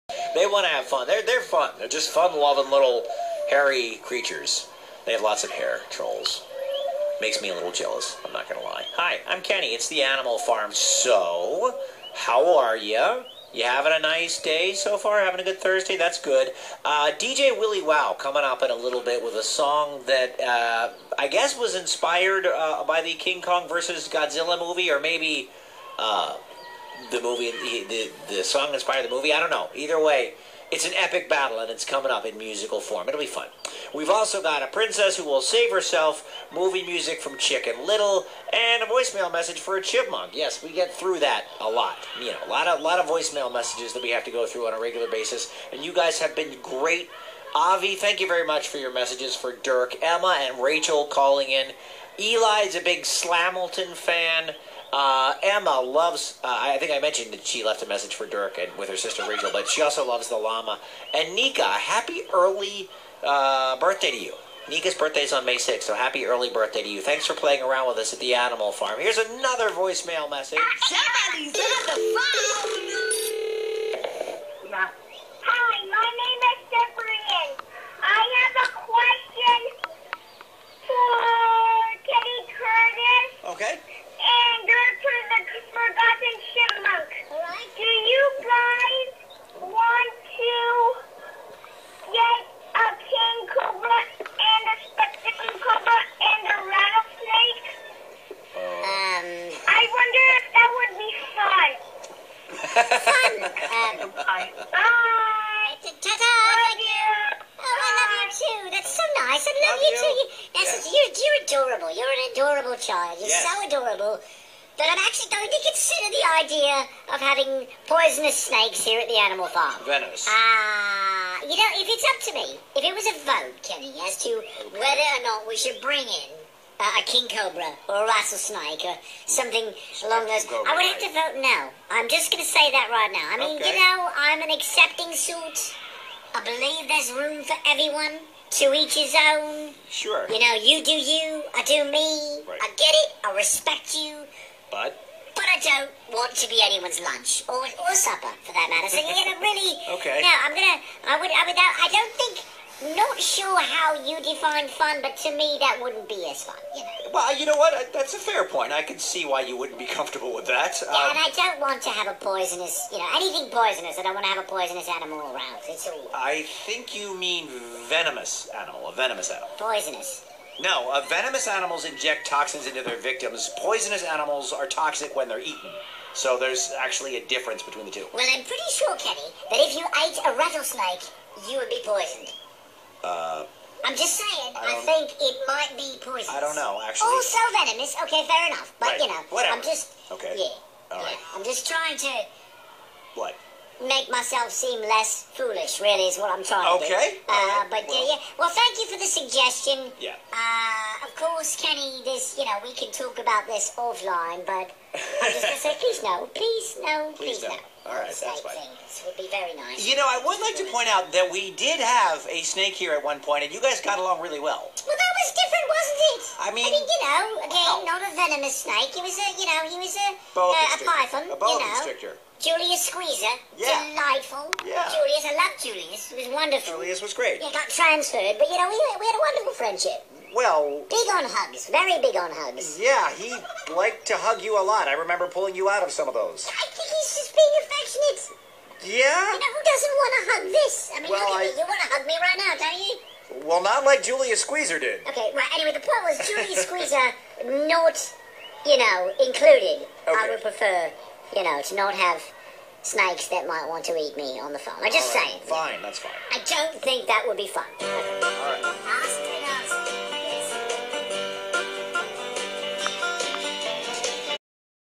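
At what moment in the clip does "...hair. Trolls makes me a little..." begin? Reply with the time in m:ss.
0:05.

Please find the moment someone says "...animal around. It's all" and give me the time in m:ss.
2:44.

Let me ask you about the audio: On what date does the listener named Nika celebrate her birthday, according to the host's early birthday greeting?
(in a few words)
May 6th.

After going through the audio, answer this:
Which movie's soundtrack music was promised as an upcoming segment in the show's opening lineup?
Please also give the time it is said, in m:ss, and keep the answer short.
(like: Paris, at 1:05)
Chicken Little, at 0:37.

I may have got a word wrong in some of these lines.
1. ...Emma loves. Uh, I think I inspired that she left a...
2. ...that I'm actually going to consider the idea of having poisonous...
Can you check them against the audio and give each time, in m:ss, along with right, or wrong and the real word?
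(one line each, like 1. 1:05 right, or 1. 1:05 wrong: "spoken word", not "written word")
1. 0:55 wrong: "mentioned", not "inspired"
2. 1:54 right.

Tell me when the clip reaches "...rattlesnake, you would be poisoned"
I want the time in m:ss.
3:00.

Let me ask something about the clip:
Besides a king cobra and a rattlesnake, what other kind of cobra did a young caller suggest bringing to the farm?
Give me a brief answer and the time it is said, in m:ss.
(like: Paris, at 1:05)
spectacle cobra, at 1:34.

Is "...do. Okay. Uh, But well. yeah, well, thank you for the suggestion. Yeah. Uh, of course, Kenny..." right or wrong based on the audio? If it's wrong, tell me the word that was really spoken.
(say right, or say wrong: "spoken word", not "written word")
right.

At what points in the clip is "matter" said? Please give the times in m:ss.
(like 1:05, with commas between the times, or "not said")
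2:28.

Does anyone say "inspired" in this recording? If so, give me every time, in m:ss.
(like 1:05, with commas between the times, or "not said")
0:21, 0:28.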